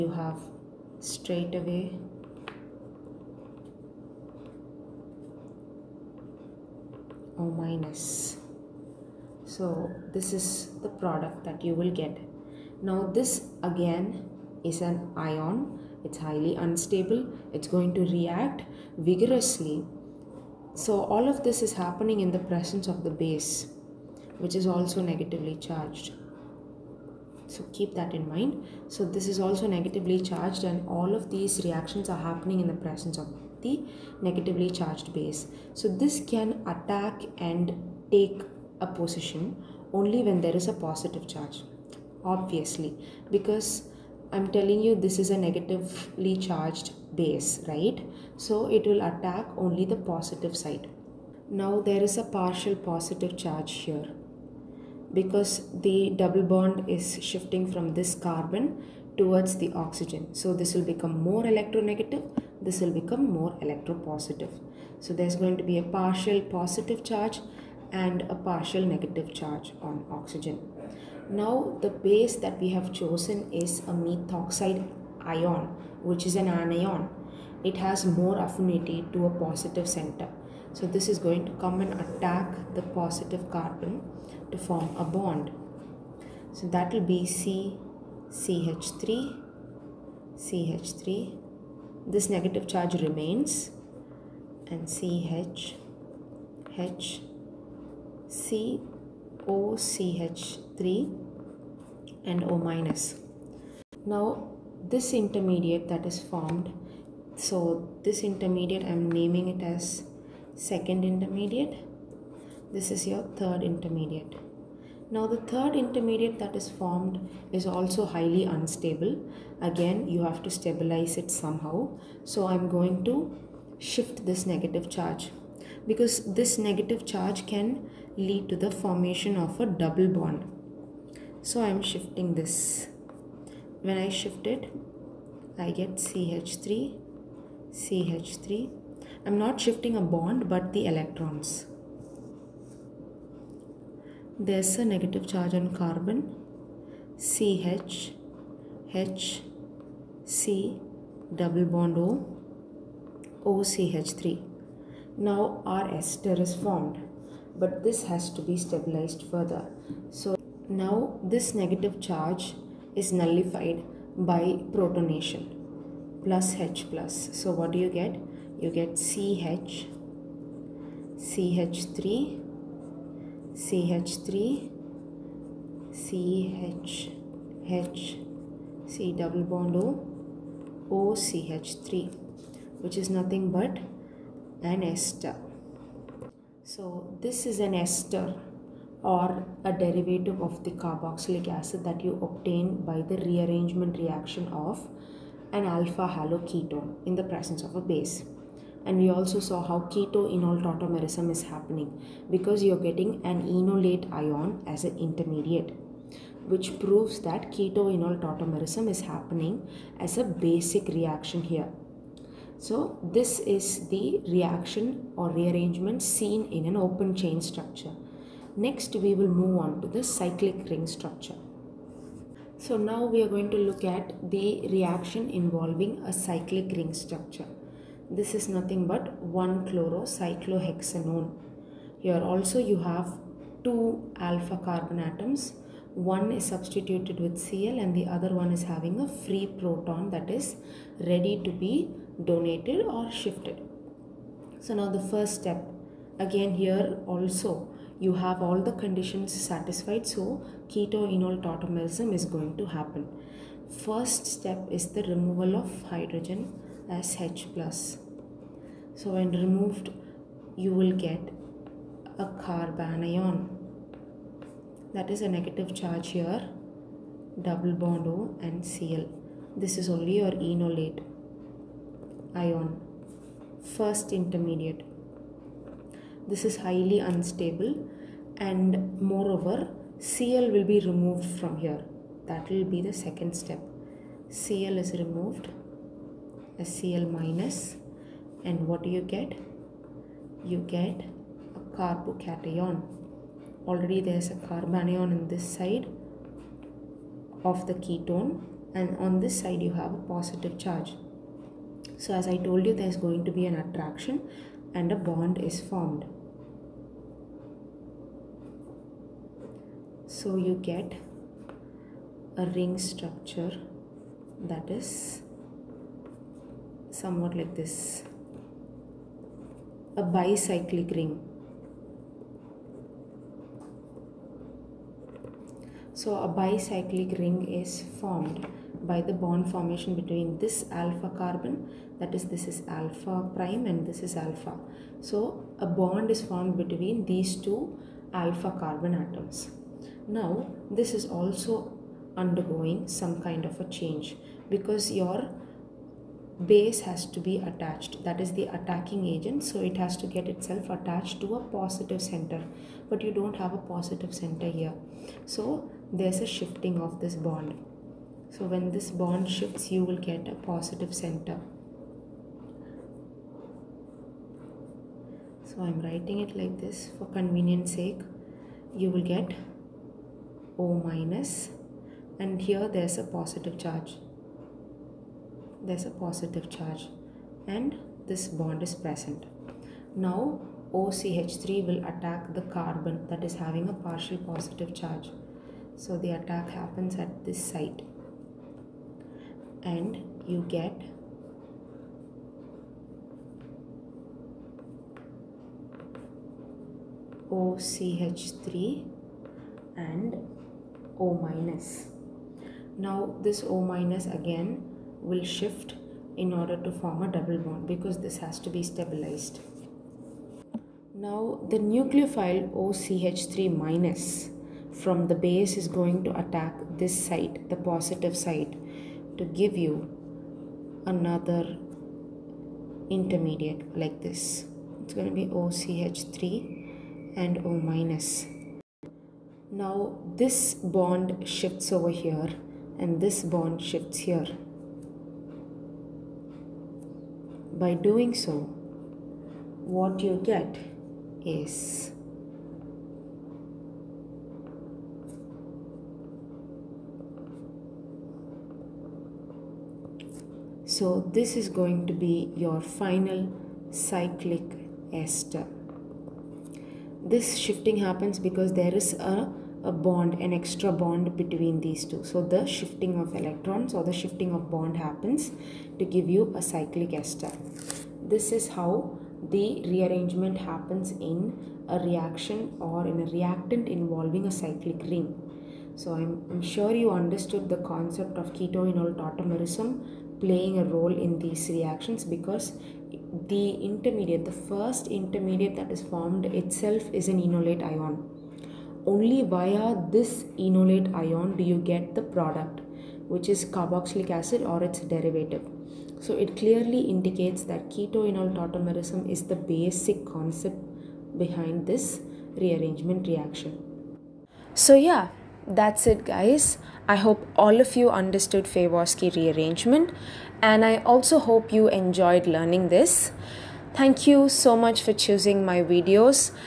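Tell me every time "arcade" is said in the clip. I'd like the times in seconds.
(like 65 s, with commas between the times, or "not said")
not said.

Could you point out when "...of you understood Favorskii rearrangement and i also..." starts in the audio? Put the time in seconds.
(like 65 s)
507 s.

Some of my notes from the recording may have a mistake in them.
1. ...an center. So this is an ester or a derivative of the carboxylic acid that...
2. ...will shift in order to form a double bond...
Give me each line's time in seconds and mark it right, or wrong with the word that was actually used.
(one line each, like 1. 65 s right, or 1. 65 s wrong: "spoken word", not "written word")
1. 184 s wrong: "ester", not "center"
2. 405 s right.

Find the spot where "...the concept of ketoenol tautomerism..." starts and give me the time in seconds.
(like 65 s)
477 s.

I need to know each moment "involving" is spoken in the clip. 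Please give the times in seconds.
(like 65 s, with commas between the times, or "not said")
225 s, 473 s.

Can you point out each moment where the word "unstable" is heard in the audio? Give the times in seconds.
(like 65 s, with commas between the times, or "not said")
16 s, 118 s, 277 s.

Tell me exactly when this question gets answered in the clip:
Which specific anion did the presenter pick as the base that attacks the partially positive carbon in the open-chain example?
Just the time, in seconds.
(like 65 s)
73 s.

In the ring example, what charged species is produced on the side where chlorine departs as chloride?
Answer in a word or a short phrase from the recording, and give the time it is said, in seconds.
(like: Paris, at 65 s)
carbocation, at 291 s.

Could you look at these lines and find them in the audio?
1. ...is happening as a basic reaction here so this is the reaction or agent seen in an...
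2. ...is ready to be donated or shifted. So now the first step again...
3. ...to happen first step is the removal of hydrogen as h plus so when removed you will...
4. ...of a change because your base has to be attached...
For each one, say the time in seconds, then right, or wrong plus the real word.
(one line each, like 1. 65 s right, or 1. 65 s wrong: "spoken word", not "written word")
1. 208 s wrong: "rearrangement", not "agent"
2. 240 s right
3. 252 s right
4. 343 s right.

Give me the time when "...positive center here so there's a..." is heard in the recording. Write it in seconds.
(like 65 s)
353 s.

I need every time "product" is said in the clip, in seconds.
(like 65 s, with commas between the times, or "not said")
11 s, 492 s.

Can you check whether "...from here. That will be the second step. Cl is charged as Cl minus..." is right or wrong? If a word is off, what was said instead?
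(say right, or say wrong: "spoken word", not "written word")
wrong: "removed", not "charged".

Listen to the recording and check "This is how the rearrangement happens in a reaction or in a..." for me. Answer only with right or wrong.
right.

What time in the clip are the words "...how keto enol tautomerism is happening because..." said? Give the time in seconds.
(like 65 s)
199 s.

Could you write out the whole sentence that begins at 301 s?
So as I told you there is going to be an attraction and a bond is formed.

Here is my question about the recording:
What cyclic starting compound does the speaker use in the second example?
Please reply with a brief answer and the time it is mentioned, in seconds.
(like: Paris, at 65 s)
1-chlorocyclohexanone, at 229 s.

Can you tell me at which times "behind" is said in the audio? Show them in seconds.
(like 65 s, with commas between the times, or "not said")
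501 s.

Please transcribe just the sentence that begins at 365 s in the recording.
So I'm writing it like this for convenience sake.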